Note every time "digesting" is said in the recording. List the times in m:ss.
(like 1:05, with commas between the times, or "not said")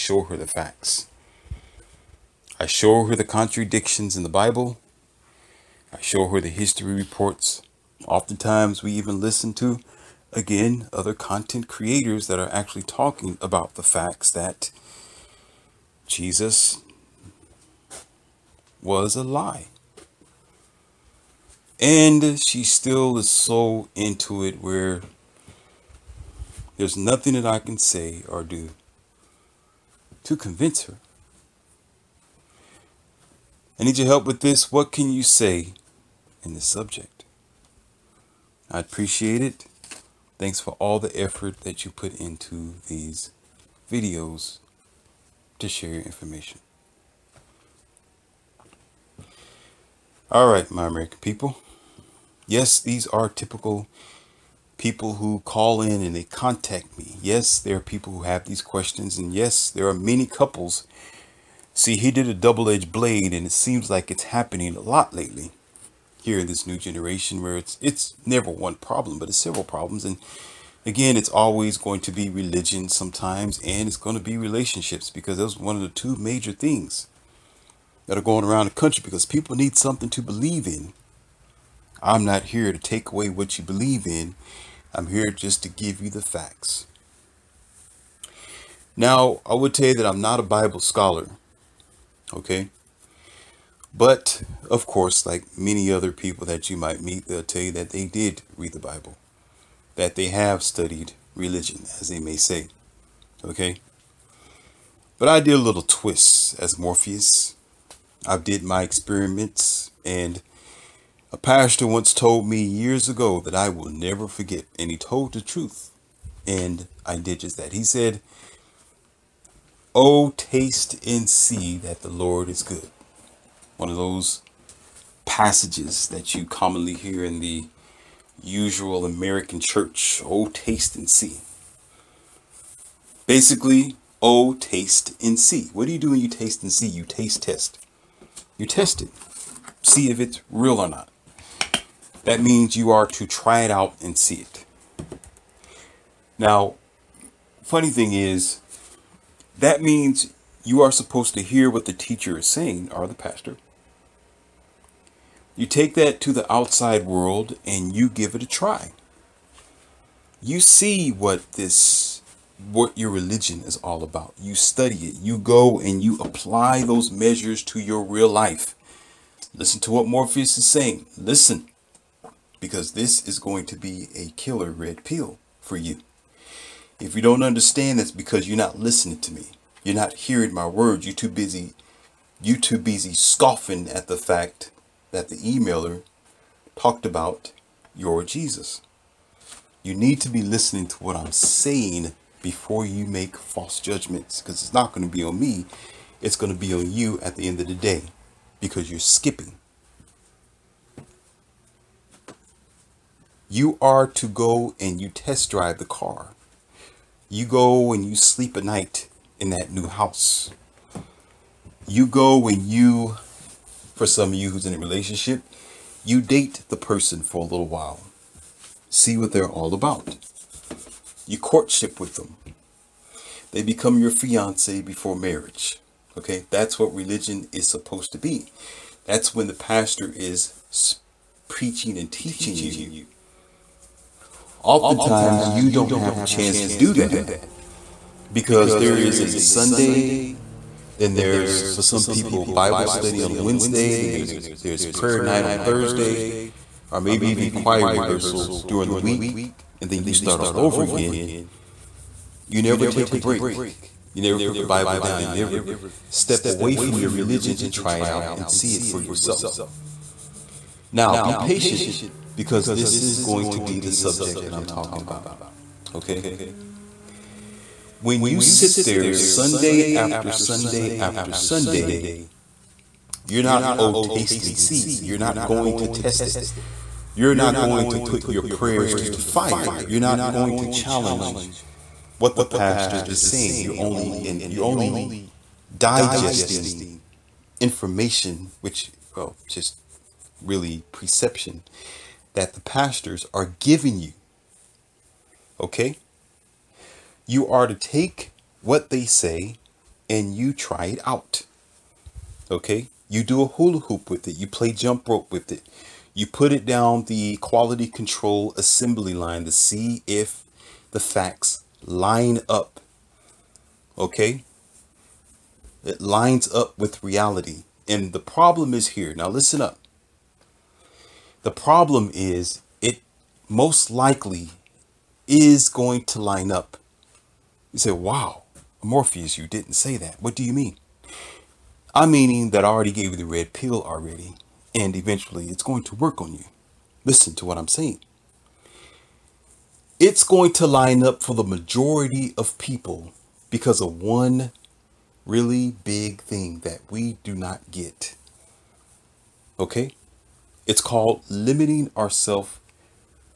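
4:45.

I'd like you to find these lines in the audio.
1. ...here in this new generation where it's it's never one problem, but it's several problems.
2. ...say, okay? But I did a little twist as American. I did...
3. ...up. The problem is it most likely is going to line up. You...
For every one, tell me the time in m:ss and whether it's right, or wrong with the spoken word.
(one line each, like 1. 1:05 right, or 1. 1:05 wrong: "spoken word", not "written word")
1. 1:06 right
2. 1:42 wrong: "Morpheus", not "American"
3. 5:19 right.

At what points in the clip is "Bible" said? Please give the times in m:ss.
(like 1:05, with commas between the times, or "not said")
0:04, 1:30, 1:38, 4:02, 4:14.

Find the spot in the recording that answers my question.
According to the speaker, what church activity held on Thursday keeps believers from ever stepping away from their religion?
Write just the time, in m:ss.
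4:04.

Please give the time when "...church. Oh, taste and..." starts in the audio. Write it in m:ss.
2:09.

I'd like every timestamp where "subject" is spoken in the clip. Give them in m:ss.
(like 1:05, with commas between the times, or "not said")
0:36, 4:23.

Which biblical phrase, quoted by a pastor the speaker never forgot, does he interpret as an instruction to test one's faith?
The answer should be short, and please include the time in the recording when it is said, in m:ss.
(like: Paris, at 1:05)
Taste and see that the Lord is good, at 2:00.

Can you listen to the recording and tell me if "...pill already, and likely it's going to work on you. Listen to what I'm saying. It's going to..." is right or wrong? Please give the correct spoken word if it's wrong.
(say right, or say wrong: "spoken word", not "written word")
wrong: "eventually", not "likely".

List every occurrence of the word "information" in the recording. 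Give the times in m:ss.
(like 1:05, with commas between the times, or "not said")
0:46, 4:47.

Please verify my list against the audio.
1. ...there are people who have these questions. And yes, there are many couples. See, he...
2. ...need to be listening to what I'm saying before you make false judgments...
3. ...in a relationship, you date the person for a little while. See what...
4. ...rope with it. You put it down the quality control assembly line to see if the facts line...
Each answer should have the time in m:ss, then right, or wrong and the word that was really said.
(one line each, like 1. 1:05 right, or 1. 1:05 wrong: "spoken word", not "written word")
1. 0:57 right
2. 3:09 right
3. 3:34 right
4. 5:05 right.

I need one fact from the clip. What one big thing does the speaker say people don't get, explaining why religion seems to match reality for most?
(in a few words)
Limiting ourselves.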